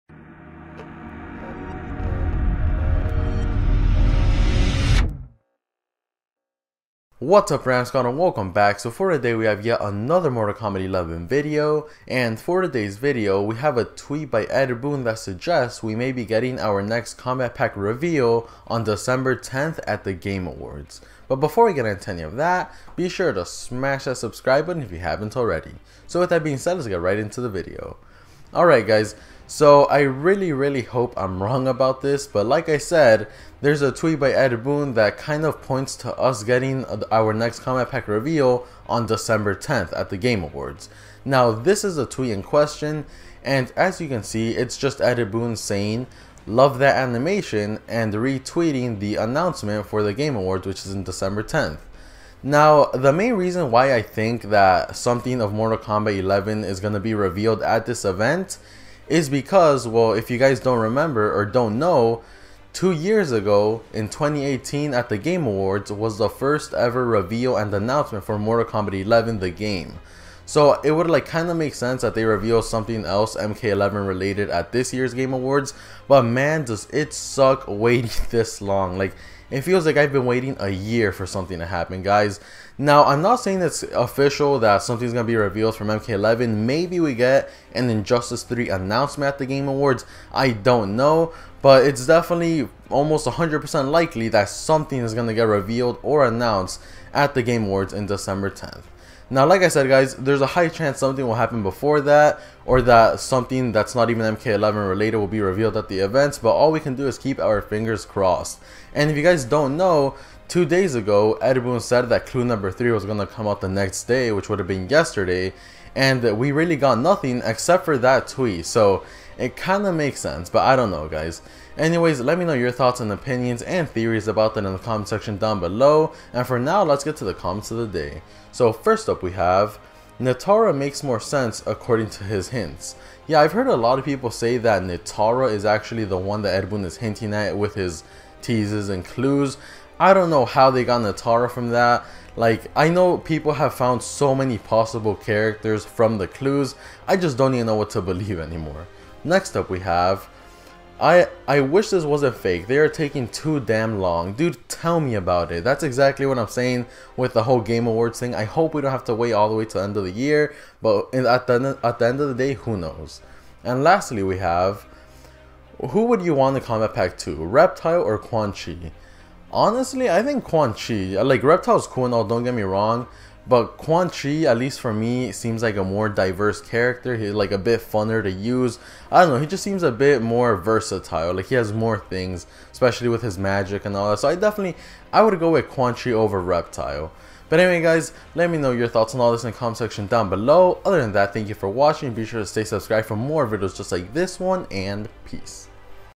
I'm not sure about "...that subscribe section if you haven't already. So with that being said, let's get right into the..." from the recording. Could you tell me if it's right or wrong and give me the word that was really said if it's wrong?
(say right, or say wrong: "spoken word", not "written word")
wrong: "button", not "section".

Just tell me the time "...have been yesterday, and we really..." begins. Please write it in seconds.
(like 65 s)
114 s.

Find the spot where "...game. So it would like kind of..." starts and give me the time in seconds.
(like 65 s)
69 s.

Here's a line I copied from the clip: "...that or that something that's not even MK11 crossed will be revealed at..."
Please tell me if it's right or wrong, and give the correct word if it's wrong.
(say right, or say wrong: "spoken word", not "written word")
wrong: "related", not "crossed".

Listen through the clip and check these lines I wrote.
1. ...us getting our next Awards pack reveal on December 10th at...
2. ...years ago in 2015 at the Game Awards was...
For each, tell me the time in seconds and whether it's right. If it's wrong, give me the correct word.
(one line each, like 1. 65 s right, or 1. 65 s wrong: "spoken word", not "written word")
1. 36 s wrong: "Kombat", not "Awards"
2. 62 s wrong: "2018", not "2015".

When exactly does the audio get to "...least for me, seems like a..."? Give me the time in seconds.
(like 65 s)
174 s.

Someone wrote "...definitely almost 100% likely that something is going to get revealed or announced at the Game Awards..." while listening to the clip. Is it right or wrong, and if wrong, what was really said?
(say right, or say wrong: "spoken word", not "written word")
right.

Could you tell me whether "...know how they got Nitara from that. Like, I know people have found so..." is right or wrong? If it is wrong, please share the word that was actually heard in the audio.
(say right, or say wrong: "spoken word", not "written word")
right.